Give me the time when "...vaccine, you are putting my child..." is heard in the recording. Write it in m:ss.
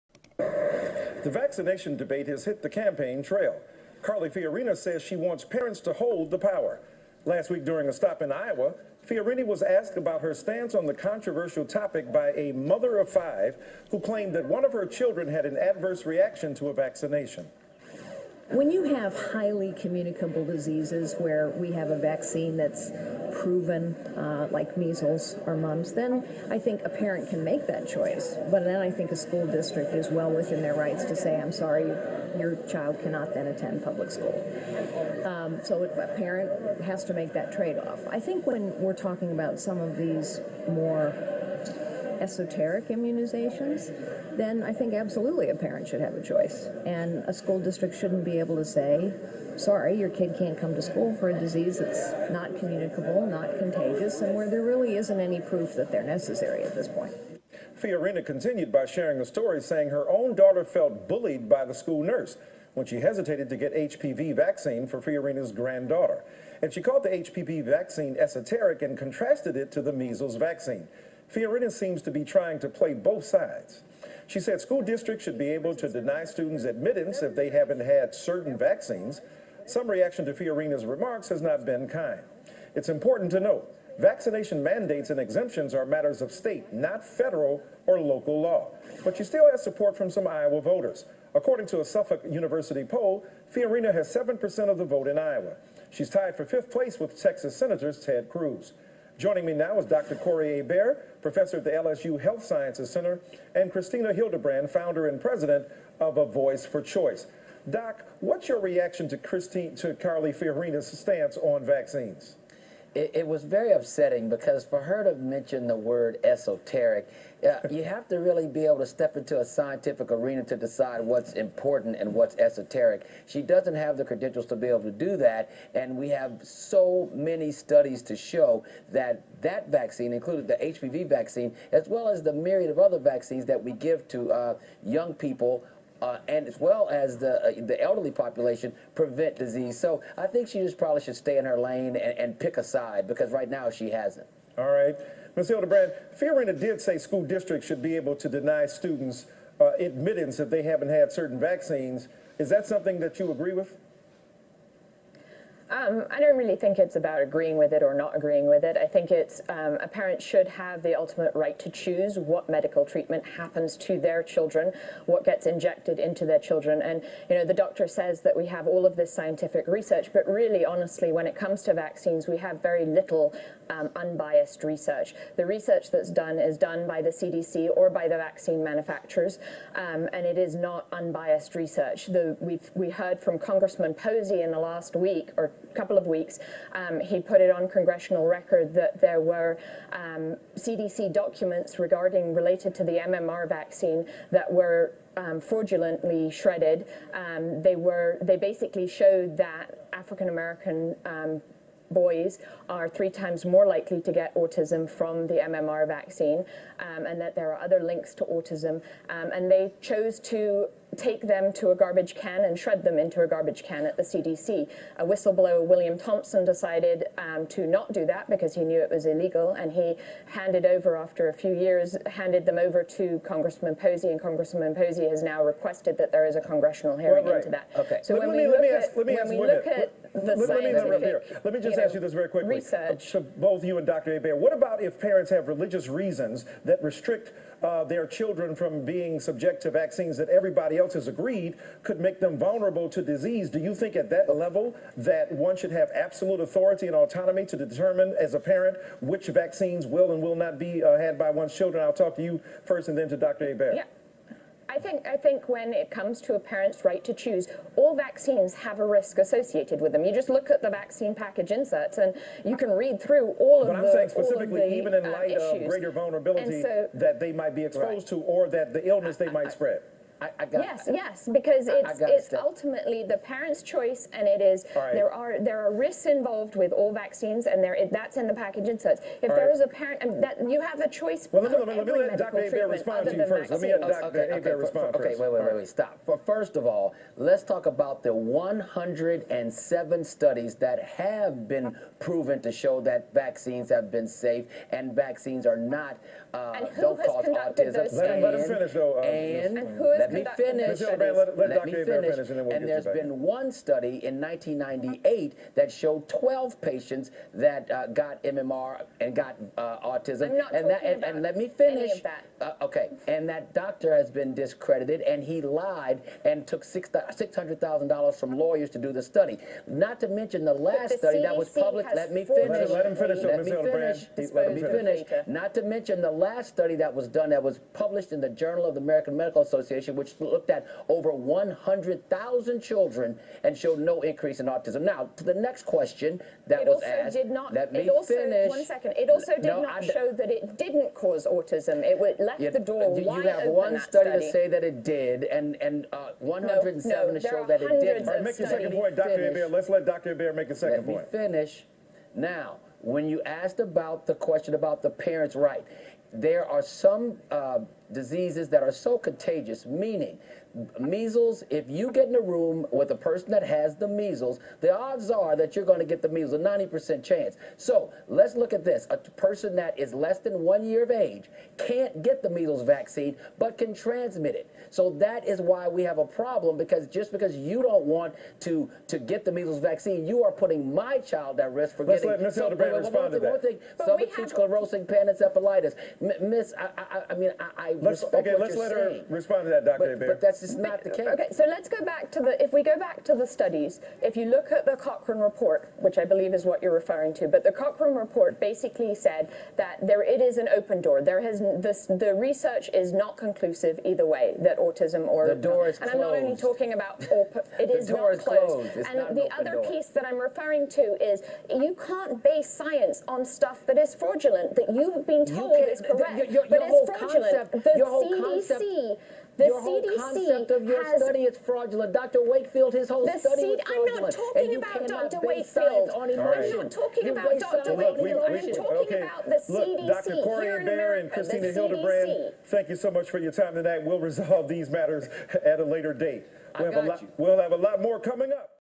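6:19.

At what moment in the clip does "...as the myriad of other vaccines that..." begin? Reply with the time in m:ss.
2:12.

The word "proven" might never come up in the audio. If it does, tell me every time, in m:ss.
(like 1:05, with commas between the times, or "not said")
0:23, 4:51.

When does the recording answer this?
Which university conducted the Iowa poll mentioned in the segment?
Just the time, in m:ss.
1:31.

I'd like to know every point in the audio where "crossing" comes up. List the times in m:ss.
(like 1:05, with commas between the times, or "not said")
not said.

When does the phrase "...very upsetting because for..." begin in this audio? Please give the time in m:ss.
1:53.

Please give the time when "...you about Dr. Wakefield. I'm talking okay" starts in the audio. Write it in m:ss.
7:07.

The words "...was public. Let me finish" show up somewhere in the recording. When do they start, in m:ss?
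5:21.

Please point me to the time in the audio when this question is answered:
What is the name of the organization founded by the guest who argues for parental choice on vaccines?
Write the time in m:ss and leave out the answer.
1:46.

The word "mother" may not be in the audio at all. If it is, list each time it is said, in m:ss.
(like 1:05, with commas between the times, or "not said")
0:12.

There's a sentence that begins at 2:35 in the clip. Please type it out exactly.
Um, I don't really think it's about agreeing with it or not agreeing with it.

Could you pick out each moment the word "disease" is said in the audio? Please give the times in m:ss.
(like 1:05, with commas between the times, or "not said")
0:20, 0:51, 2:19, 4:03, 5:57.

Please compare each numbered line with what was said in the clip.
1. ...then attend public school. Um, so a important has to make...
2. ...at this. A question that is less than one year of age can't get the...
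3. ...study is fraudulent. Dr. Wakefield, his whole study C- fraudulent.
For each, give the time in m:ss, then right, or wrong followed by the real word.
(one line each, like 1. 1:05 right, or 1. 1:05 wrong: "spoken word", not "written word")
1. 0:33 wrong: "parent", not "important"
2. 6:08 wrong: "person", not "question"
3. 7:01 right.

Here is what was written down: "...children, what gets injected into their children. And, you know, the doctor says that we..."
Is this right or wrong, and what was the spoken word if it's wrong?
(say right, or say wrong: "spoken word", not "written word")
right.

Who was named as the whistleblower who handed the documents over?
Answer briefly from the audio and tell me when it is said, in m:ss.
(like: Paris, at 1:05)
William Thompson, at 3:35.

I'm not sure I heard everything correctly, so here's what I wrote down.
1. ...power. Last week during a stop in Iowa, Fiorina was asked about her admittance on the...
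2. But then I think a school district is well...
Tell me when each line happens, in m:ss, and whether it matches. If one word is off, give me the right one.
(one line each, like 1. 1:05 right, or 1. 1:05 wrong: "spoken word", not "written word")
1. 0:06 wrong: "stance", not "admittance"
2. 0:28 right.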